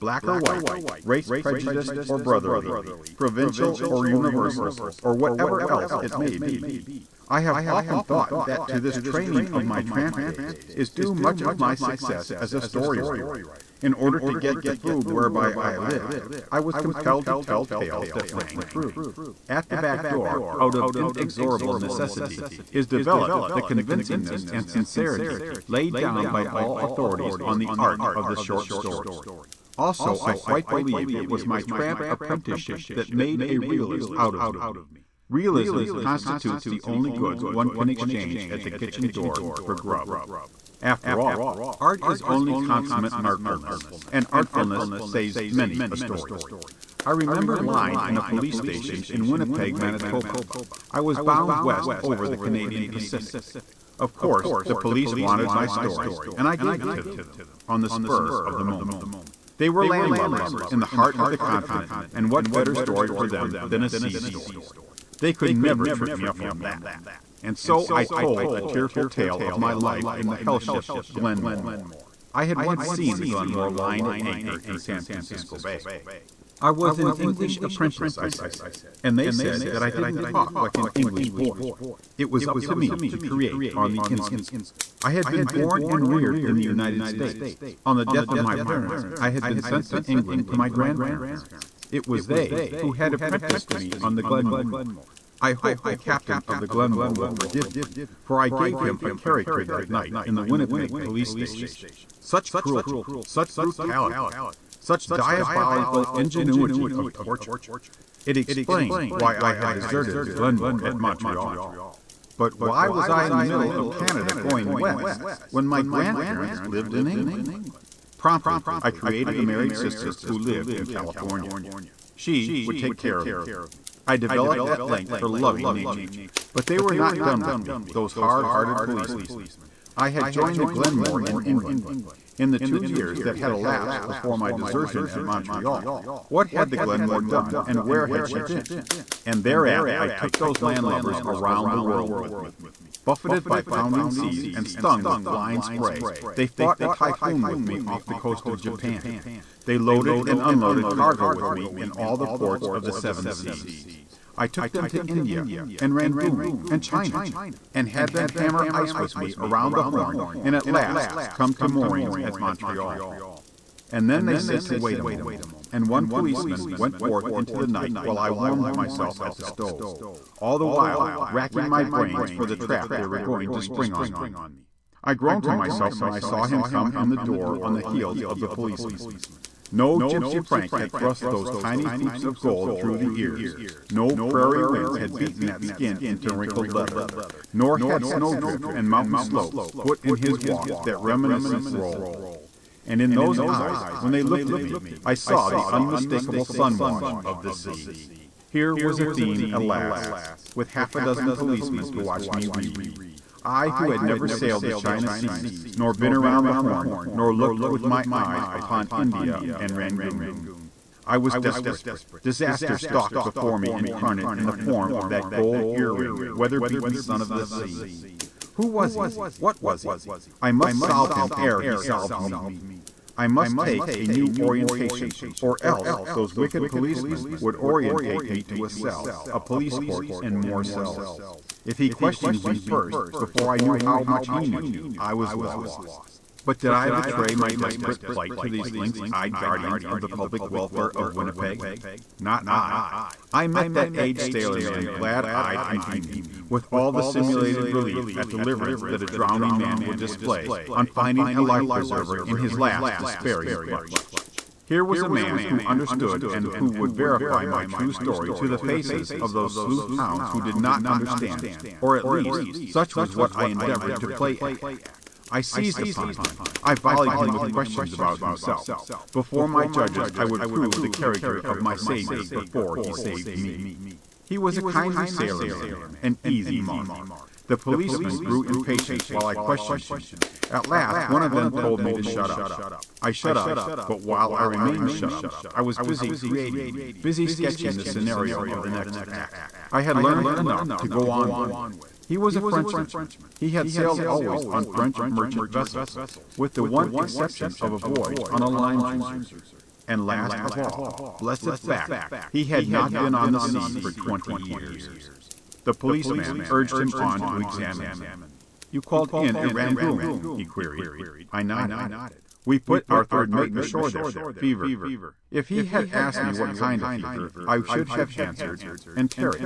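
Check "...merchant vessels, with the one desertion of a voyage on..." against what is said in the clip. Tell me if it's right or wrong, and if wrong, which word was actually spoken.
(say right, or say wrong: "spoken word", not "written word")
wrong: "exception", not "desertion".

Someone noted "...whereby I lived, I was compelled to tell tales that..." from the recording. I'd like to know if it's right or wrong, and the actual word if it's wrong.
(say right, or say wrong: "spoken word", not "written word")
right.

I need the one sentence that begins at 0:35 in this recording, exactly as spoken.
Realism constitutes the only goods one can exchange at the kitchen door for grub.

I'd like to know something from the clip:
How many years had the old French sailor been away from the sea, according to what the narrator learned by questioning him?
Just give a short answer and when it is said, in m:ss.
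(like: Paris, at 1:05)
20, at 5:03.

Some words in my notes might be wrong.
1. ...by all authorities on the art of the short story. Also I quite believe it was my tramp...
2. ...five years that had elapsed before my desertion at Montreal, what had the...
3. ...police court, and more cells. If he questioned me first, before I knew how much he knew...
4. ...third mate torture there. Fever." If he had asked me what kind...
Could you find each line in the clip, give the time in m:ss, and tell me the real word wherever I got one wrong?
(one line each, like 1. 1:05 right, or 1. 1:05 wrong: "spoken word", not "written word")
1. 0:26 right
2. 2:12 wrong: "two", not "five"
3. 3:49 right
4. 5:13 wrong: "ashore", not "torture".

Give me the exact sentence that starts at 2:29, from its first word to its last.
They loaded and unloaded cargo with me in all the ports of the seven seas.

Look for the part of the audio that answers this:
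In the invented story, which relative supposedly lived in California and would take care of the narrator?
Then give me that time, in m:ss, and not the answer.
1:59.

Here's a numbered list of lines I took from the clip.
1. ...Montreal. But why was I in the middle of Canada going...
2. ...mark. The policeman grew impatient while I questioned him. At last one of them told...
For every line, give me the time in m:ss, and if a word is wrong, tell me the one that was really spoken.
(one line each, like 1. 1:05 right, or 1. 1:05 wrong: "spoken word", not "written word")
1. 1:50 right
2. 4:36 right.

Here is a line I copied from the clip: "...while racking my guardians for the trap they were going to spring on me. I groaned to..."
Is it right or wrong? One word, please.
wrong.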